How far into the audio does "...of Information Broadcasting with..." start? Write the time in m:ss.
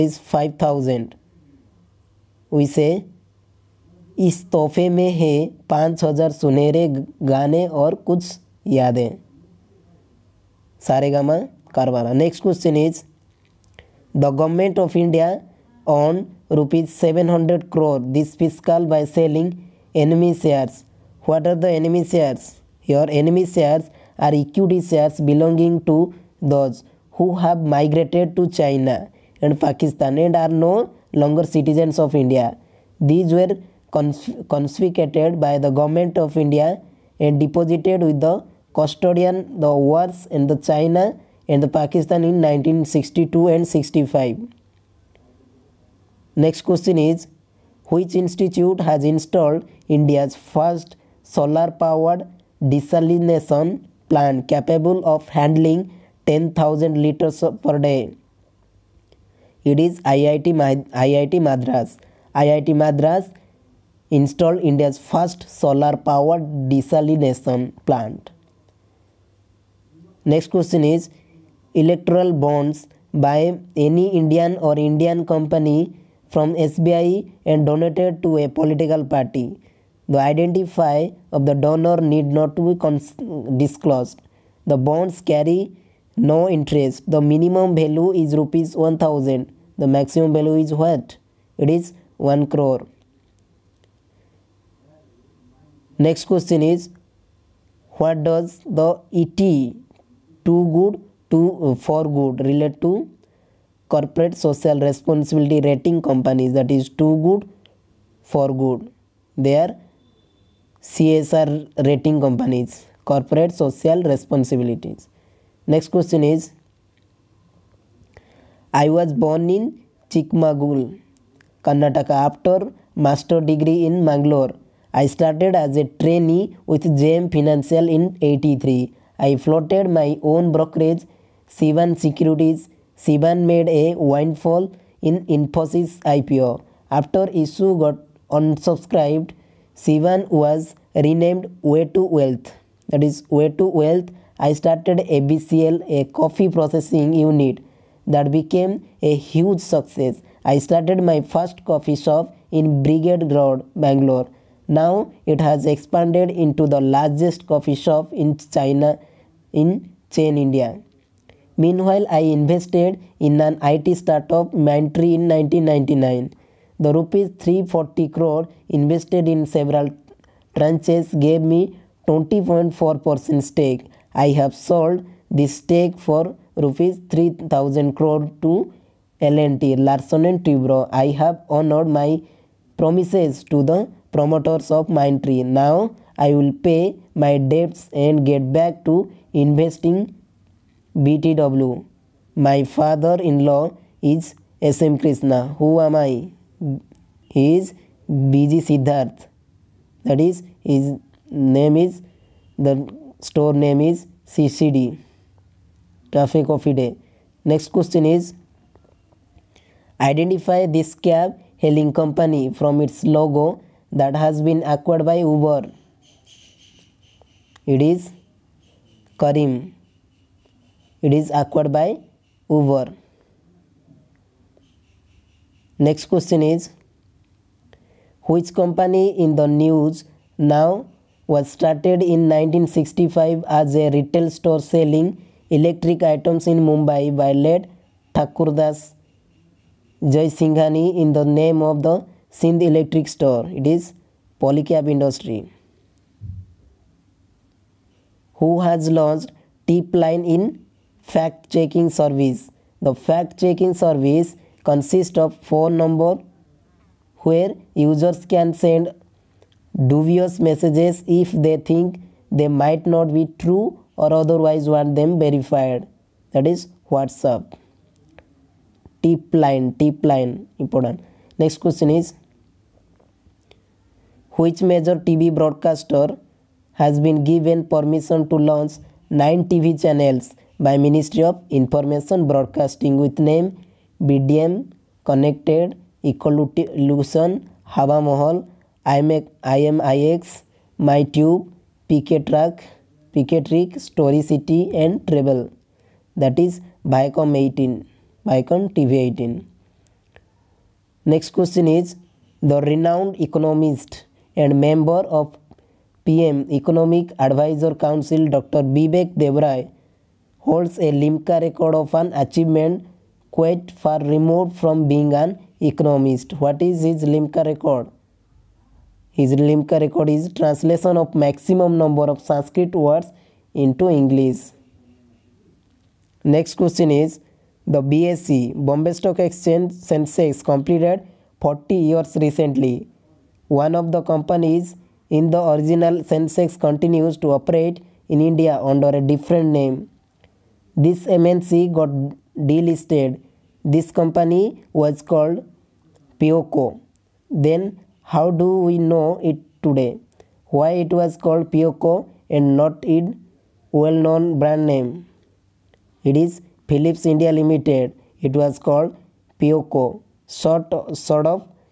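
4:41.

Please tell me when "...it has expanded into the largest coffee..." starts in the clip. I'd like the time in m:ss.
2:35.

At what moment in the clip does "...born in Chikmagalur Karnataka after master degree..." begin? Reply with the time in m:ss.
1:59.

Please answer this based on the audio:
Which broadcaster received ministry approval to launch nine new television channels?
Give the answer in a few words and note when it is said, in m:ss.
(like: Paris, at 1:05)
Viacom 18, at 4:56.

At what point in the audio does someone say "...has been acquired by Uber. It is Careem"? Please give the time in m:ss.
3:34.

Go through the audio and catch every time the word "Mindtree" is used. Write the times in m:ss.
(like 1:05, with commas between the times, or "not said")
2:44, 3:04.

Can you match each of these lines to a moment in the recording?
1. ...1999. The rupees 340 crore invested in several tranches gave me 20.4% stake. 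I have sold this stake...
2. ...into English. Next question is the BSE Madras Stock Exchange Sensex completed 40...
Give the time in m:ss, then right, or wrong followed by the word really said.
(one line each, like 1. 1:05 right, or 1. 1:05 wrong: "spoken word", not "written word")
1. 2:45 right
2. 5:23 wrong: "Bombay", not "Madras".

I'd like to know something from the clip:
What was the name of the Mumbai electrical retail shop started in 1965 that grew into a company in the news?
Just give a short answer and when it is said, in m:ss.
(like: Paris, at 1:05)
Sindh Electric Store, at 4:02.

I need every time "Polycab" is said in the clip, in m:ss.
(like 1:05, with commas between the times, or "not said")
4:04.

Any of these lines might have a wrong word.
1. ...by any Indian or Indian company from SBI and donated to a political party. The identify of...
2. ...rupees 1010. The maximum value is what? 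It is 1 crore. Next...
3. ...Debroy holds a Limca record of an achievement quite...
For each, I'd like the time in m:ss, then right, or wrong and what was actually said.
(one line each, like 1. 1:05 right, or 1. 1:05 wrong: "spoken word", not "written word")
1. 1:13 right
2. 1:28 wrong: "1000", not "1010"
3. 5:09 right.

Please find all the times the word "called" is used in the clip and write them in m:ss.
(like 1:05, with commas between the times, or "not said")
5:45, 5:51, 5:58.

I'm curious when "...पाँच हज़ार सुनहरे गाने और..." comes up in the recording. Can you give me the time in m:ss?
0:05.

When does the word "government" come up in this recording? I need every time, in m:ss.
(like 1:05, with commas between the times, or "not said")
0:14, 0:35.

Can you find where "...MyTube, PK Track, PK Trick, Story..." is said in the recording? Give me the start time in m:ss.
4:50.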